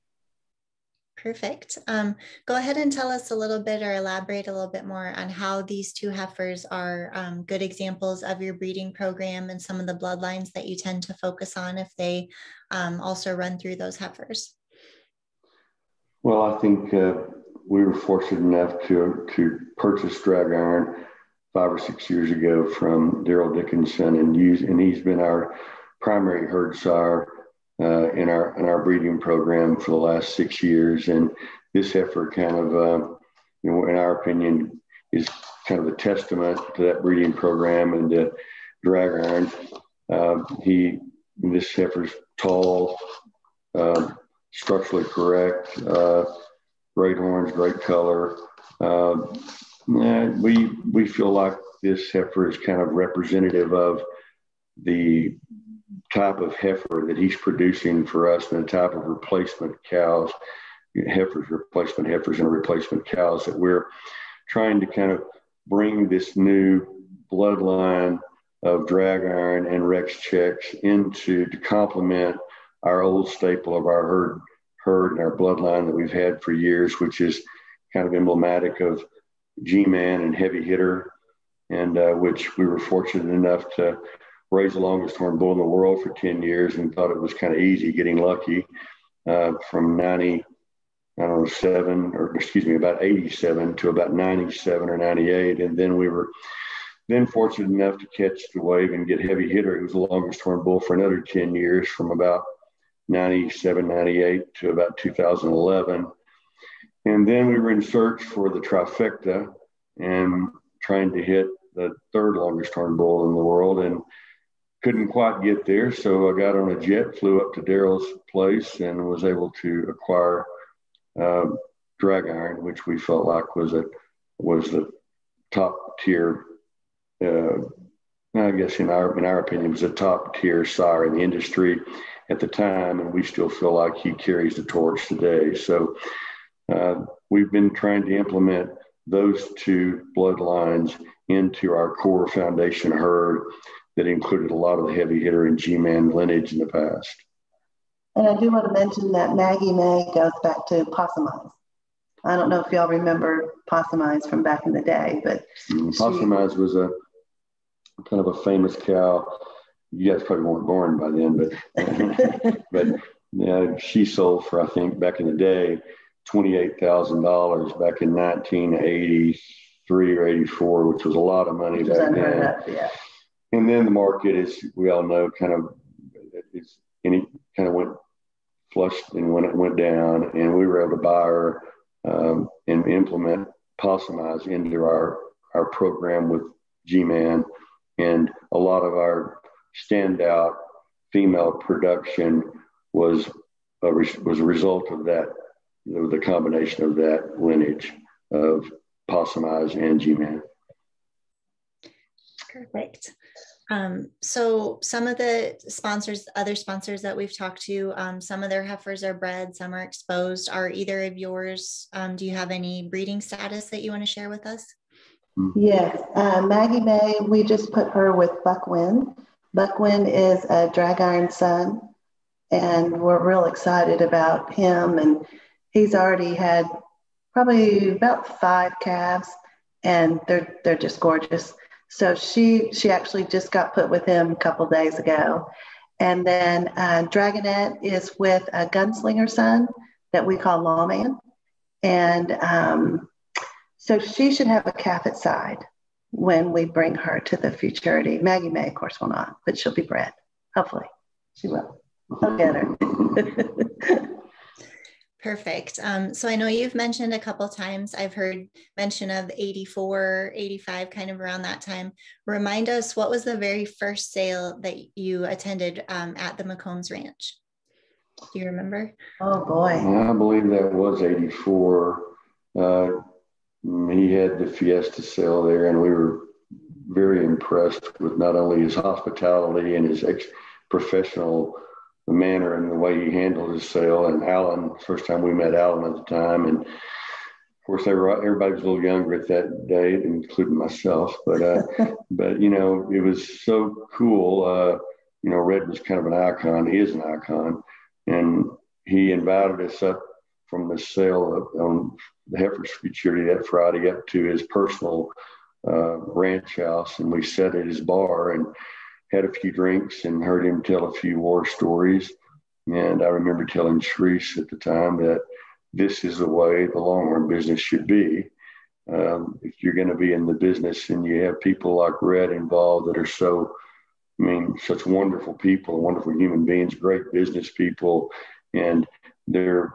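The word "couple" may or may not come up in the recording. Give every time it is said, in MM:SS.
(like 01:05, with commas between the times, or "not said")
03:54, 04:17.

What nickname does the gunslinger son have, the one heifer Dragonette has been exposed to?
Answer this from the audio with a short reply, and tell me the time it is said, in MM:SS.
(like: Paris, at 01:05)
Lawman, at 04:00.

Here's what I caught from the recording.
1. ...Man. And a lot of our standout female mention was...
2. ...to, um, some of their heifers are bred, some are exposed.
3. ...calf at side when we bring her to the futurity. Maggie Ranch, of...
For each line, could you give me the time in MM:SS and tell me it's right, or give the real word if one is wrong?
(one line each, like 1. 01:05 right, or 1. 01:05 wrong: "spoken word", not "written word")
1. 03:07 wrong: "production", not "mention"
2. 03:27 right
3. 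04:04 wrong: "May", not "Ranch".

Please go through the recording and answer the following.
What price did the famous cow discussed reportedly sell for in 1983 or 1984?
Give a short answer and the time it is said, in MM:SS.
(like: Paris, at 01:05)
$28,000, at 02:46.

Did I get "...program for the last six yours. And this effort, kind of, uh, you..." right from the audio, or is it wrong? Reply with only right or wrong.
wrong.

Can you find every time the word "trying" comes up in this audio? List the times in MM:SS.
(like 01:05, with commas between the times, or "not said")
01:04, 01:50, 02:17.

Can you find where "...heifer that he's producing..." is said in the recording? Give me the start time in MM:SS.
00:56.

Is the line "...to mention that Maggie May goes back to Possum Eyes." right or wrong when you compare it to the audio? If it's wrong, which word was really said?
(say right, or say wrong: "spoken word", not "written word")
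right.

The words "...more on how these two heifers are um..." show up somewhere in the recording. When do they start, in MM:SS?
00:04.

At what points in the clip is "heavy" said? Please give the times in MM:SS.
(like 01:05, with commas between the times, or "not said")
01:20, 01:39, 02:24.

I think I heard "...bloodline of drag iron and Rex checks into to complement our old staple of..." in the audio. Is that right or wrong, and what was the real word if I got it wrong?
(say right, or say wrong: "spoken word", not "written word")
right.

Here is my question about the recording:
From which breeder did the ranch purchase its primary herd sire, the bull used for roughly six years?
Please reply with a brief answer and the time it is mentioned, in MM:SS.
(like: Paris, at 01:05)
Darol Dickinson, at 00:23.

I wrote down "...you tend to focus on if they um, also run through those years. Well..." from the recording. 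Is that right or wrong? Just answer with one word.
wrong.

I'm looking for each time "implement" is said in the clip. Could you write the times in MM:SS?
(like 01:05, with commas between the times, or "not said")
02:18, 03:02.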